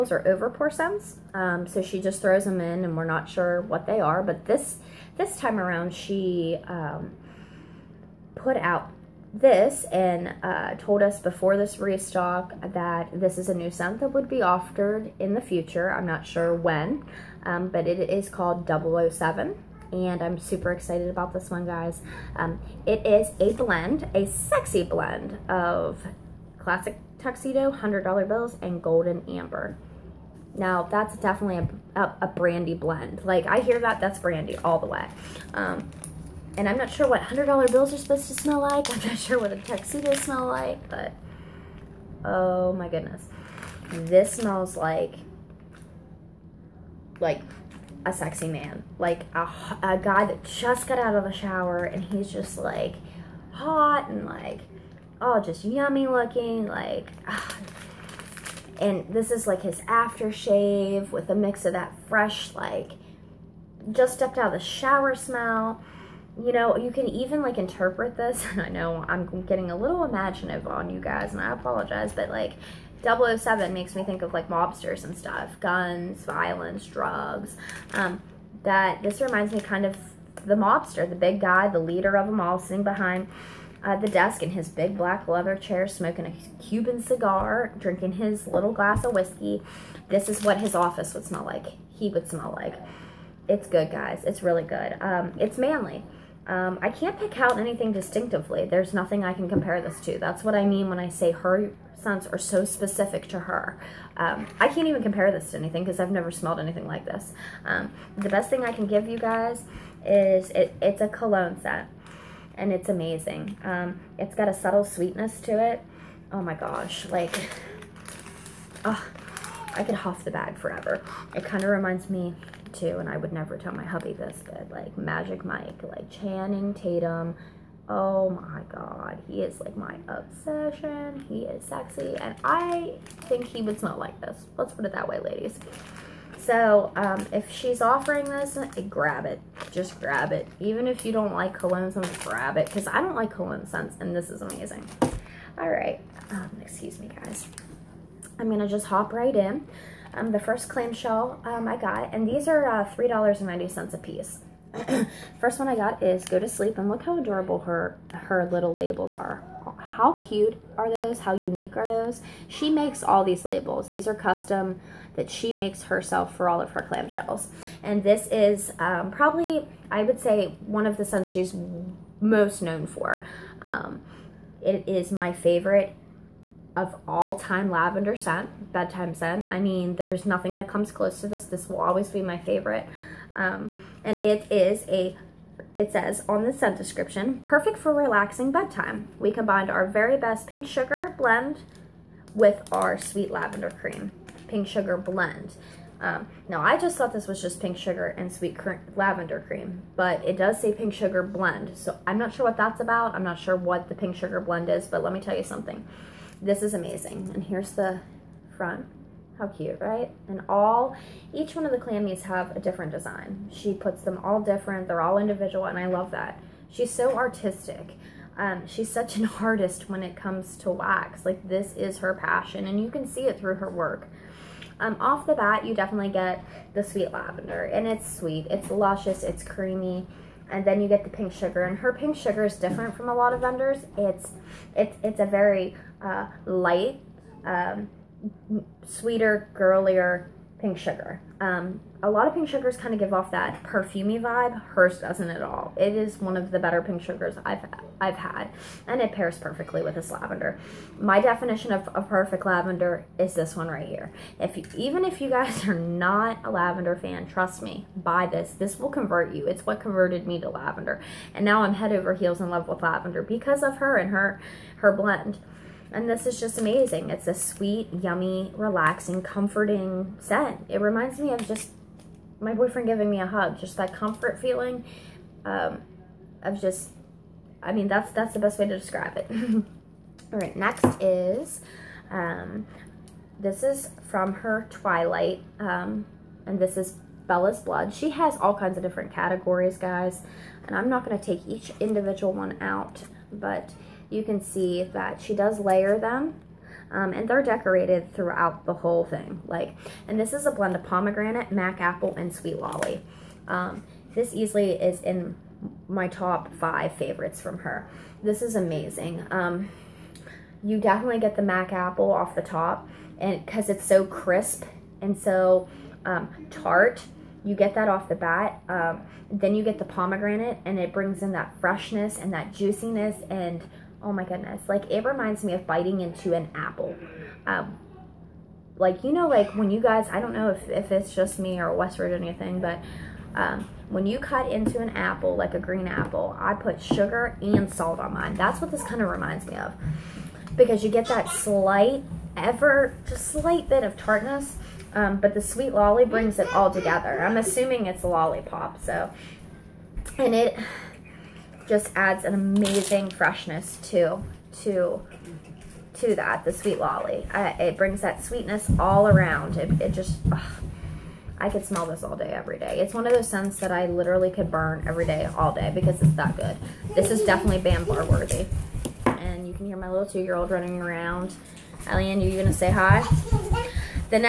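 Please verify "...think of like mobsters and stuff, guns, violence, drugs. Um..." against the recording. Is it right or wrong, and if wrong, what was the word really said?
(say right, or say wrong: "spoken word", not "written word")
right.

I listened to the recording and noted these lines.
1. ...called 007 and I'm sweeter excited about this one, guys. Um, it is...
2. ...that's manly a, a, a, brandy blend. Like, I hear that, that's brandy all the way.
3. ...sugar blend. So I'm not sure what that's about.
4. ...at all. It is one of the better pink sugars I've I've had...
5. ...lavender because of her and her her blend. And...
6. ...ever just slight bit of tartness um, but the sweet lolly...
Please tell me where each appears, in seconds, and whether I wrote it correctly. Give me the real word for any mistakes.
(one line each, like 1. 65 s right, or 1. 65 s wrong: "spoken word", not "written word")
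1. 18 s wrong: "super", not "sweeter"
2. 30 s wrong: "definitely", not "manly"
3. 200 s right
4. 245 s right
5. 262 s right
6. 342 s right.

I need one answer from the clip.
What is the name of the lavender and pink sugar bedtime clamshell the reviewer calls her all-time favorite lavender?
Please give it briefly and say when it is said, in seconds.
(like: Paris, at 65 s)
Go to Sleep, at 156 s.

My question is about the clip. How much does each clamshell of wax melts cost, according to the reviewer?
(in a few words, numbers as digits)
$3.90.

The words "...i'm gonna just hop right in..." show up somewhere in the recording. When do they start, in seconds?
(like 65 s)
148 s.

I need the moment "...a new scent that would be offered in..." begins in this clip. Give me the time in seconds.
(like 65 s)
13 s.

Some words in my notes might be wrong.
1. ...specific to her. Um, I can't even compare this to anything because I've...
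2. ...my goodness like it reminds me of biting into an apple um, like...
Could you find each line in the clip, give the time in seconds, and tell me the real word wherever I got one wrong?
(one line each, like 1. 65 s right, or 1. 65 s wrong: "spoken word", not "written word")
1. 102 s right
2. 324 s right.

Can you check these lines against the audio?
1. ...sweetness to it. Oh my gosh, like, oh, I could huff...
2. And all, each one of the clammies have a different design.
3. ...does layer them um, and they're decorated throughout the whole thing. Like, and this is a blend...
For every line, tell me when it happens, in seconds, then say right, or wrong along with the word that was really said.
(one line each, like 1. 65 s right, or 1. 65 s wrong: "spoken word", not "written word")
1. 114 s right
2. 210 s right
3. 295 s right.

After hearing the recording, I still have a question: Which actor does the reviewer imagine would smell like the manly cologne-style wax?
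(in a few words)
Channing Tatum.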